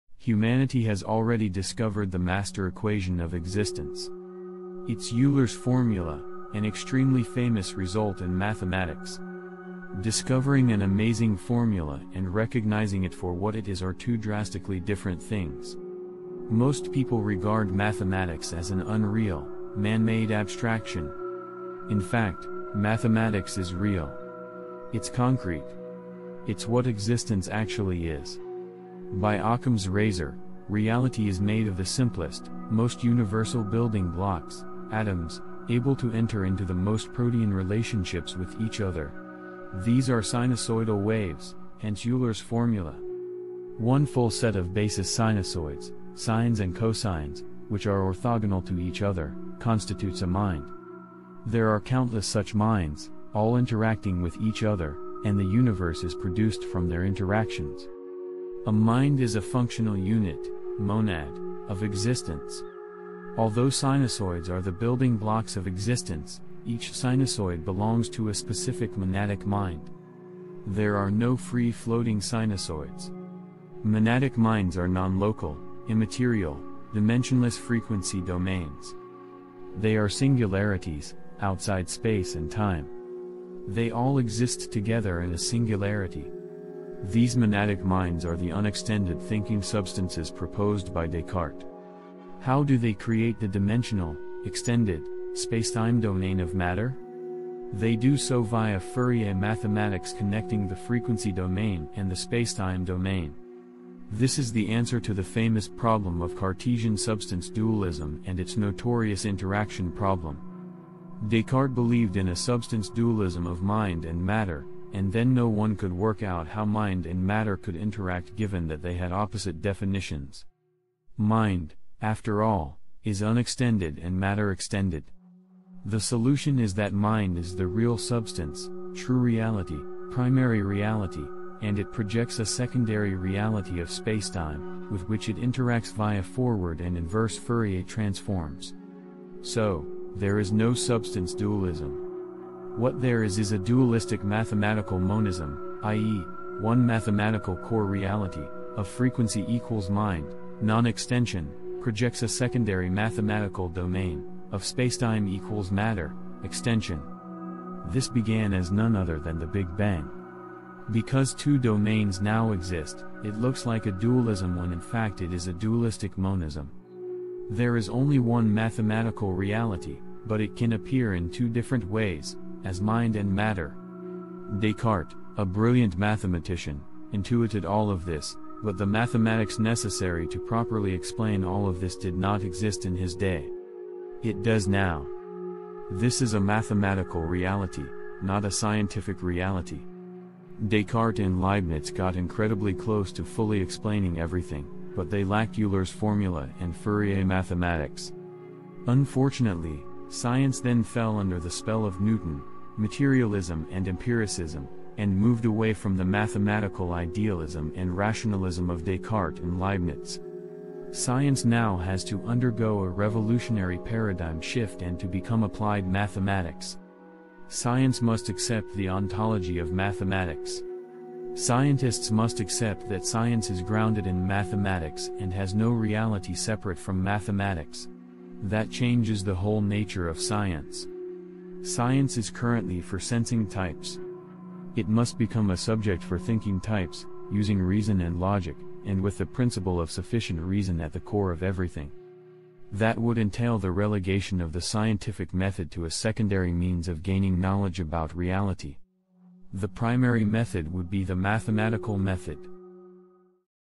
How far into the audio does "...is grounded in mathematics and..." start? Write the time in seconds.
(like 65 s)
223 s.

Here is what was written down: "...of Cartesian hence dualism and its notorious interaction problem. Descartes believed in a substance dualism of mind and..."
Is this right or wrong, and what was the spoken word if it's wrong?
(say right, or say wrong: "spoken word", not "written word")
wrong: "substance", not "hence".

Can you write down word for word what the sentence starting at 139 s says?
So, there is no substance dualism.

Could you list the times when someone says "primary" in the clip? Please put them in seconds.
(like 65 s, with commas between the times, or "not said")
130 s, 249 s.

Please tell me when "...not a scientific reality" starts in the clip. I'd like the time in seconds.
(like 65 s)
188 s.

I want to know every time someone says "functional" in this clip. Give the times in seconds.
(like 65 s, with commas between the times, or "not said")
59 s.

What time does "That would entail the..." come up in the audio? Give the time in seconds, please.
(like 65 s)
242 s.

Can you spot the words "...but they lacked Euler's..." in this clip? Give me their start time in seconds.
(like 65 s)
194 s.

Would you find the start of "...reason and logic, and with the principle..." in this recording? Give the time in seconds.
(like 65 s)
237 s.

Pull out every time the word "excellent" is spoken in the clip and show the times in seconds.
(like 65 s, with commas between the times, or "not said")
not said.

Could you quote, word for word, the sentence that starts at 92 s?
How do they create the dimensional, extended, spacetime domain of matter?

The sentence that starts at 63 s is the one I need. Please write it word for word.
Although sinusoids are the building blocks of existence, each sinusoid belongs to a specific monadic mind.